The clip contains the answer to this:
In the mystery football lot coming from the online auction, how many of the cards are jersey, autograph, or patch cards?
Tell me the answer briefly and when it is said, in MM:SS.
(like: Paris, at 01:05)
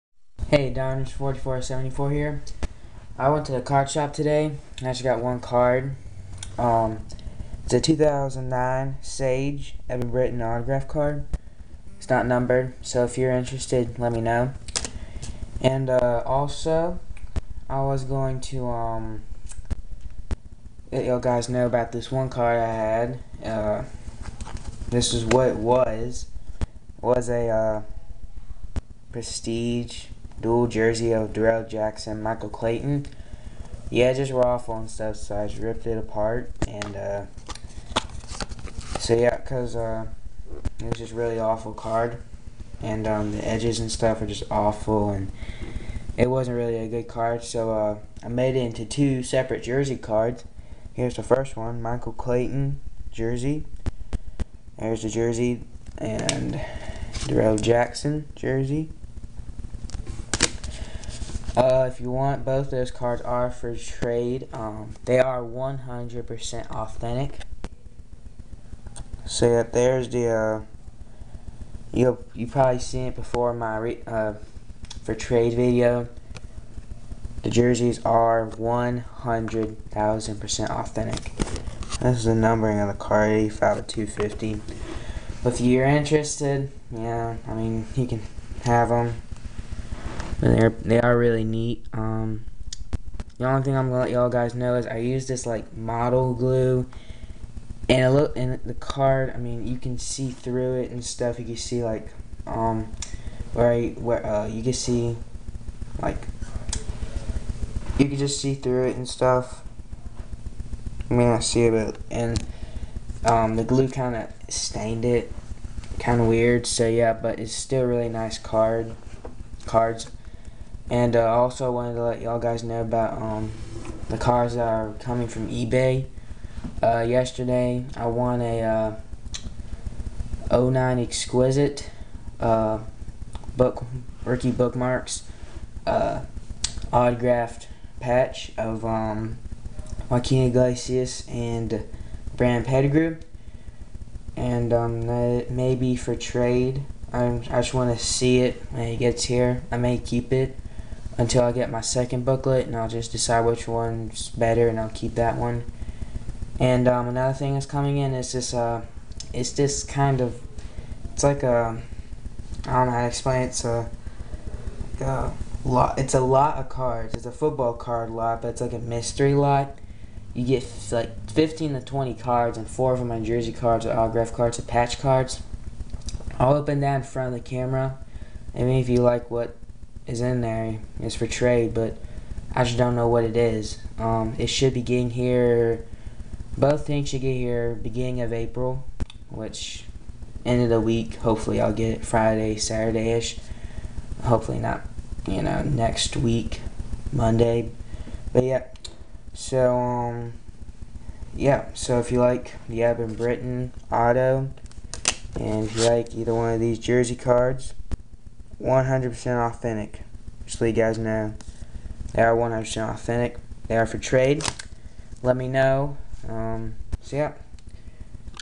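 4, at 02:52.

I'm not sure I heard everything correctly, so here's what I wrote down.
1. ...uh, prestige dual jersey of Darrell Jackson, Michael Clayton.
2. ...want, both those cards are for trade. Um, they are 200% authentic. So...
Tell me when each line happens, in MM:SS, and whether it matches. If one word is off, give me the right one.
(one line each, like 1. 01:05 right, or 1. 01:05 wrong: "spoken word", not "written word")
1. 00:27 right
2. 01:02 wrong: "100", not "200".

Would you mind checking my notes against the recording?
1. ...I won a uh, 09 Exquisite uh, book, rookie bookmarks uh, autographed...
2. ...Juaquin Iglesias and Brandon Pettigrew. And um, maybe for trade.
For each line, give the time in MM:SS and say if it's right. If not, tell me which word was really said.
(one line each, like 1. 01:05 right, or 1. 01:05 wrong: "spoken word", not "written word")
1. 02:07 right
2. 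02:20 right.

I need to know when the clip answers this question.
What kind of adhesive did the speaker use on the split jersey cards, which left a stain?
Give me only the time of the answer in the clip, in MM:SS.
01:35.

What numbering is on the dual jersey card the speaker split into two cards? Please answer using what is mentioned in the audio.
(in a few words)
85 to 250.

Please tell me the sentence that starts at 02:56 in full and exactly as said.
All up and down in front of the camera.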